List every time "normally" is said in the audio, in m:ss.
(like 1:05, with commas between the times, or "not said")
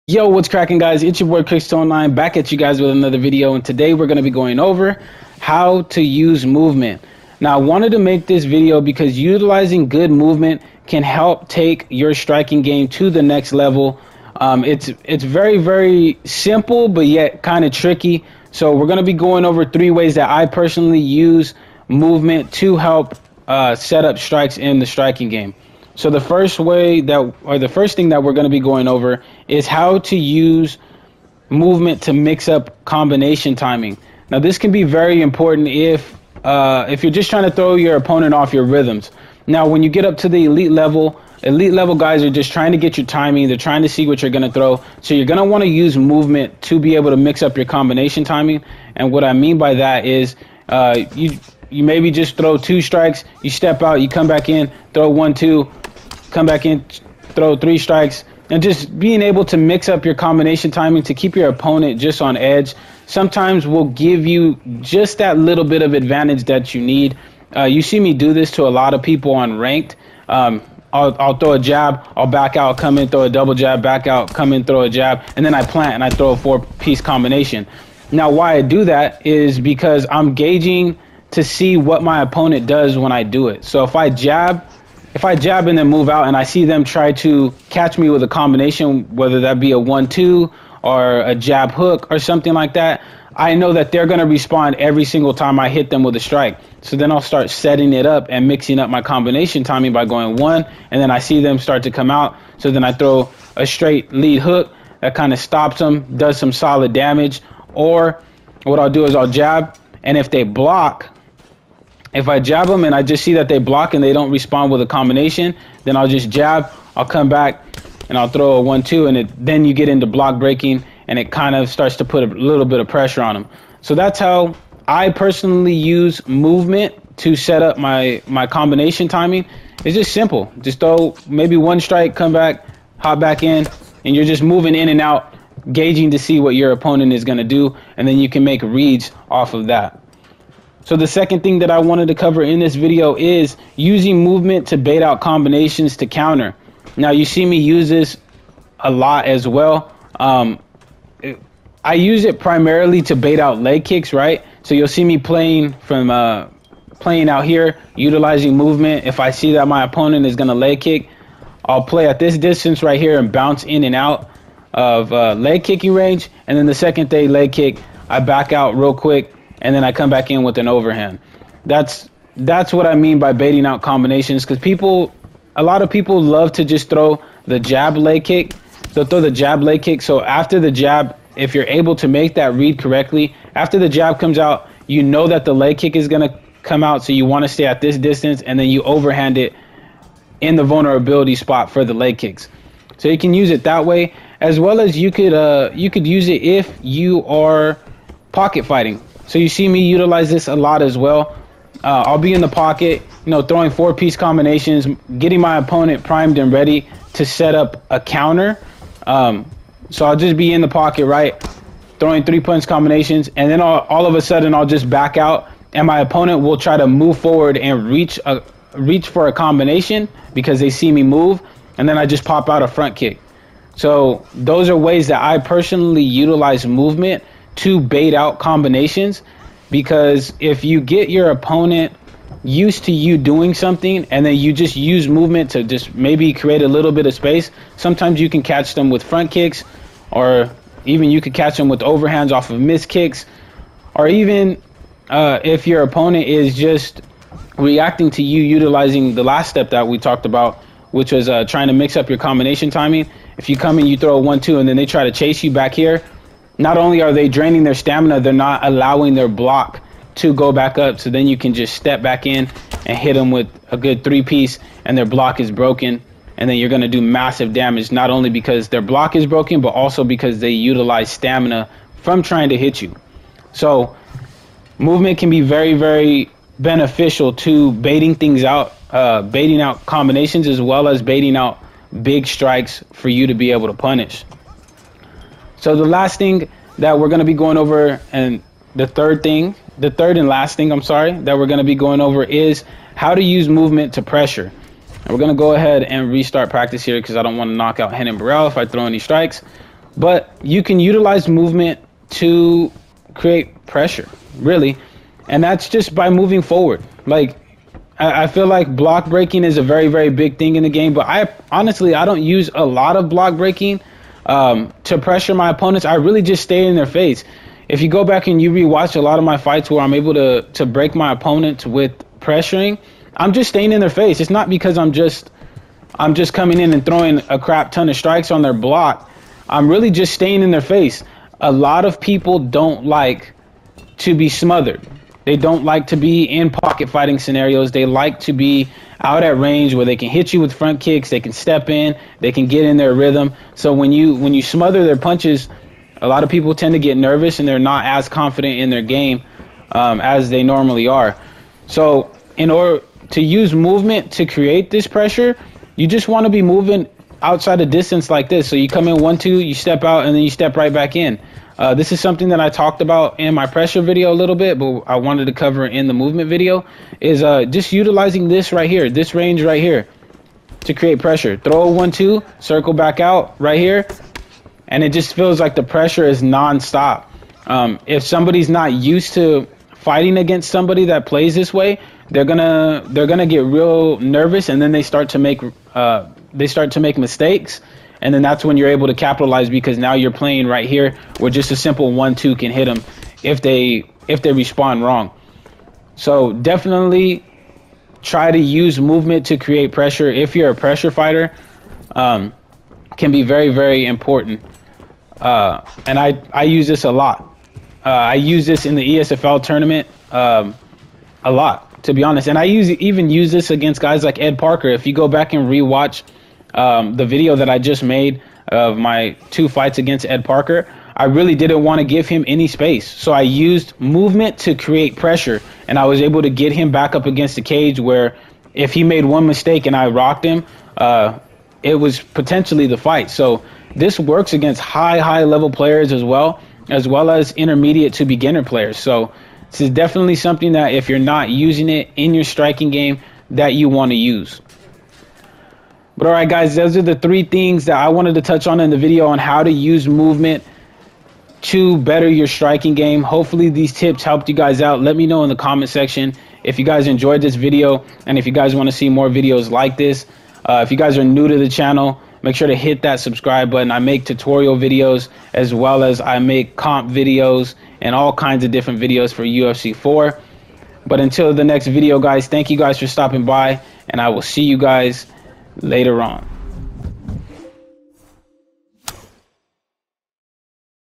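5:50.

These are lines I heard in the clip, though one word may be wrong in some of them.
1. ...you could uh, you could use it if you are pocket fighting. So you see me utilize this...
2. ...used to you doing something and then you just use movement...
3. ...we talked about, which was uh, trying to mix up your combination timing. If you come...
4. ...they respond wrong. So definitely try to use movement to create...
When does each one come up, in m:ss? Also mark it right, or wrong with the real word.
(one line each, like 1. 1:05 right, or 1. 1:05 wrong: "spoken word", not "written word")
1. 3:14 right
2. 3:52 right
3. 4:09 right
4. 6:34 right.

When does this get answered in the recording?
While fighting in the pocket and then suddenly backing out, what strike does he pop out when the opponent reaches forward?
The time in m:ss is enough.
3:42.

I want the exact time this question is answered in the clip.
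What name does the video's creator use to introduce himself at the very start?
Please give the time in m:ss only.
0:01.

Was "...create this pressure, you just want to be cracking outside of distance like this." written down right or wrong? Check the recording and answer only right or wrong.
wrong.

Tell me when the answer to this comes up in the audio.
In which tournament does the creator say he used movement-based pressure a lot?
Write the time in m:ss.
6:48.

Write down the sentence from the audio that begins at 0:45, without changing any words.
So you're going to want to use movement to be able to mix up your combination timing.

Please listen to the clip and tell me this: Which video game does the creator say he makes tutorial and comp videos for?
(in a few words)
UFC 4.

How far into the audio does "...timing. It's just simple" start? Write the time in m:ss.
2:09.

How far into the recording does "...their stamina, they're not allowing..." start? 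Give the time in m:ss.
4:17.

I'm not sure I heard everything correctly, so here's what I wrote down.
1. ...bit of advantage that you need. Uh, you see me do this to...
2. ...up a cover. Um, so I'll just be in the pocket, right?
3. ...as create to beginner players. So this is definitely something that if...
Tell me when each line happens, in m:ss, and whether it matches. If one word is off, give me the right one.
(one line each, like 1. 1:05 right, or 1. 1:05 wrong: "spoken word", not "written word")
1. 1:05 right
2. 3:27 wrong: "counter", not "cover"
3. 7:17 wrong: "intermediate", not "create".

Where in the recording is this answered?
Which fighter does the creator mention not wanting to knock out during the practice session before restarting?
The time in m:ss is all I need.
4:57.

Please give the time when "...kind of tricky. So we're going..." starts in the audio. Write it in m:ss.
0:17.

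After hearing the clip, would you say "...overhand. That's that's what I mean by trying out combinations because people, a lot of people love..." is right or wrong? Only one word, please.
wrong.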